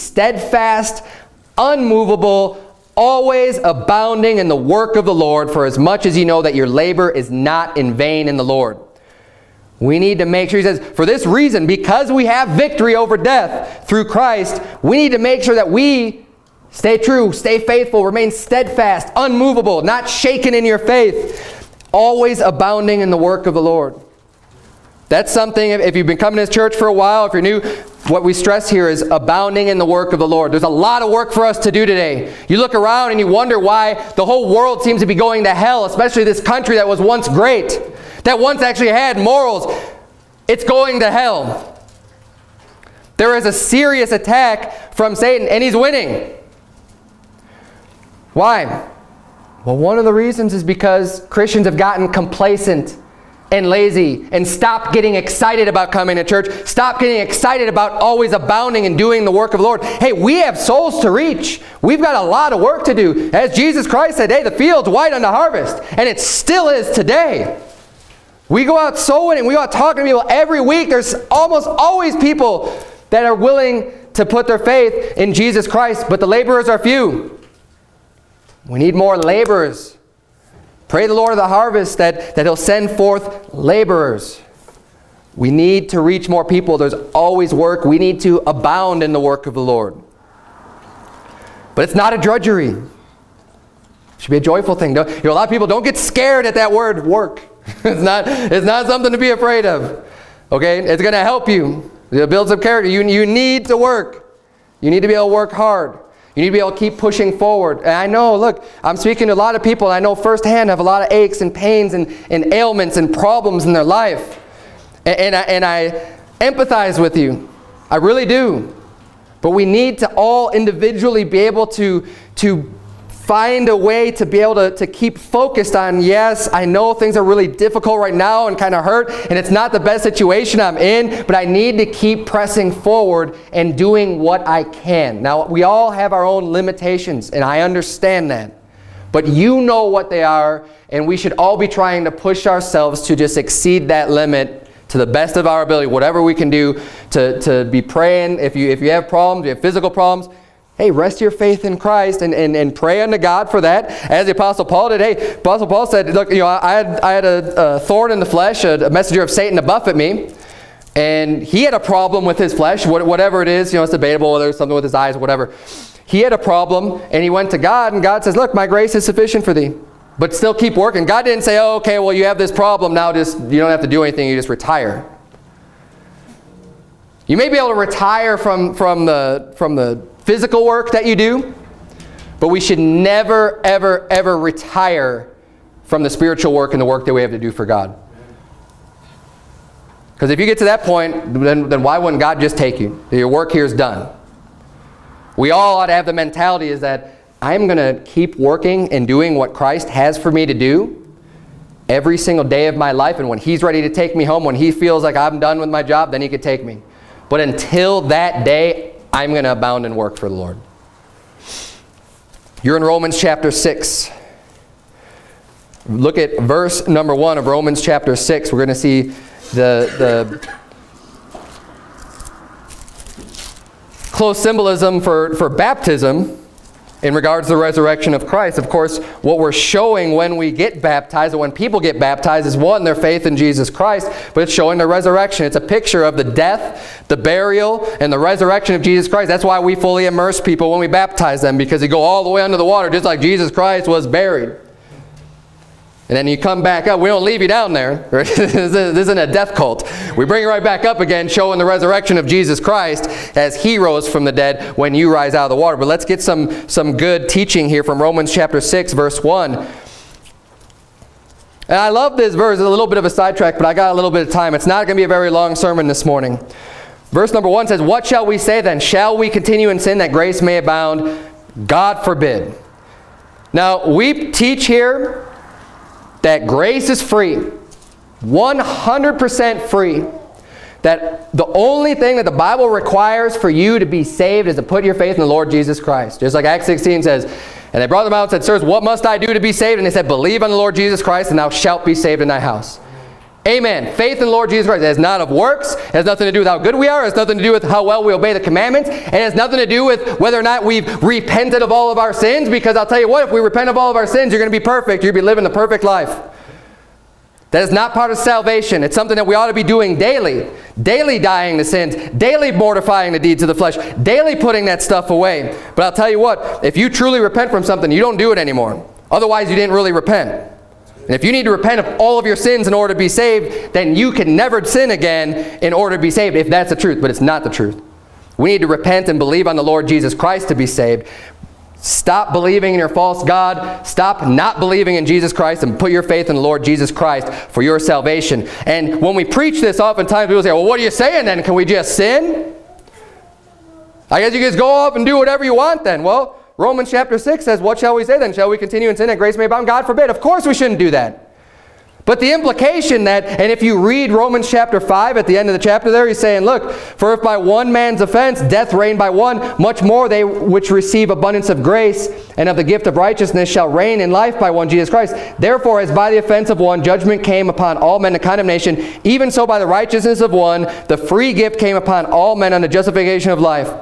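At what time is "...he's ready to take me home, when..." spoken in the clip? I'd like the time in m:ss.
3:23.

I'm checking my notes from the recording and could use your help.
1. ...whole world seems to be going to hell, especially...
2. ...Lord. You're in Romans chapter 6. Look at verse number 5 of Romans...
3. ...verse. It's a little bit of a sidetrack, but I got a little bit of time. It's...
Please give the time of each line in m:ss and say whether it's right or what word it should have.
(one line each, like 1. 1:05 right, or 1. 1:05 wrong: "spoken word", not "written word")
1. 0:34 right
2. 3:30 wrong: "1", not "5"
3. 4:22 right.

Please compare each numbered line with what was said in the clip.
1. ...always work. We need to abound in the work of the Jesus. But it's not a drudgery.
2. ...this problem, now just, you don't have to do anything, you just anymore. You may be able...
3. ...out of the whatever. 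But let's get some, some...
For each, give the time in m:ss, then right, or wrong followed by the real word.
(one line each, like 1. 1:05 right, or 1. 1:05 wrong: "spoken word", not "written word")
1. 1:27 wrong: "Lord", not "Jesus"
2. 2:52 wrong: "retire", not "anymore"
3. 4:15 wrong: "water", not "whatever".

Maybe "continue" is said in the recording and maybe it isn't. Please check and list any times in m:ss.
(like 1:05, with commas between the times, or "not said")
4:29, 5:48.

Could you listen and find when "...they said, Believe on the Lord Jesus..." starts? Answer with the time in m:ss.
4:49.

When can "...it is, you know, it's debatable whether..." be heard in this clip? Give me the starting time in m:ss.
2:43.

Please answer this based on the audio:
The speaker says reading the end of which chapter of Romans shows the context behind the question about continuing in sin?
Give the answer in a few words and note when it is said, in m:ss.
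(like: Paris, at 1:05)
Romans chapter 5, at 5:54.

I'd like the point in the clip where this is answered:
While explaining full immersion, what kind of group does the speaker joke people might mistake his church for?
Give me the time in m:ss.
4:09.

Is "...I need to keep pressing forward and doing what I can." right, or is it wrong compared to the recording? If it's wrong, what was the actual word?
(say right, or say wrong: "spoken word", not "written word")
right.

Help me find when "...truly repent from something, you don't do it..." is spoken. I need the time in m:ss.
5:16.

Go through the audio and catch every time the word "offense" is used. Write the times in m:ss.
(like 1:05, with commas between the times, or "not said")
5:58, 6:06.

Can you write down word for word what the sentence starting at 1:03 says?
As Jesus Christ said, hey, the field's white unto harvest.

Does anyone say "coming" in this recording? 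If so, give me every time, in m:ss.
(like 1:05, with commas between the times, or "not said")
0:26, 0:55.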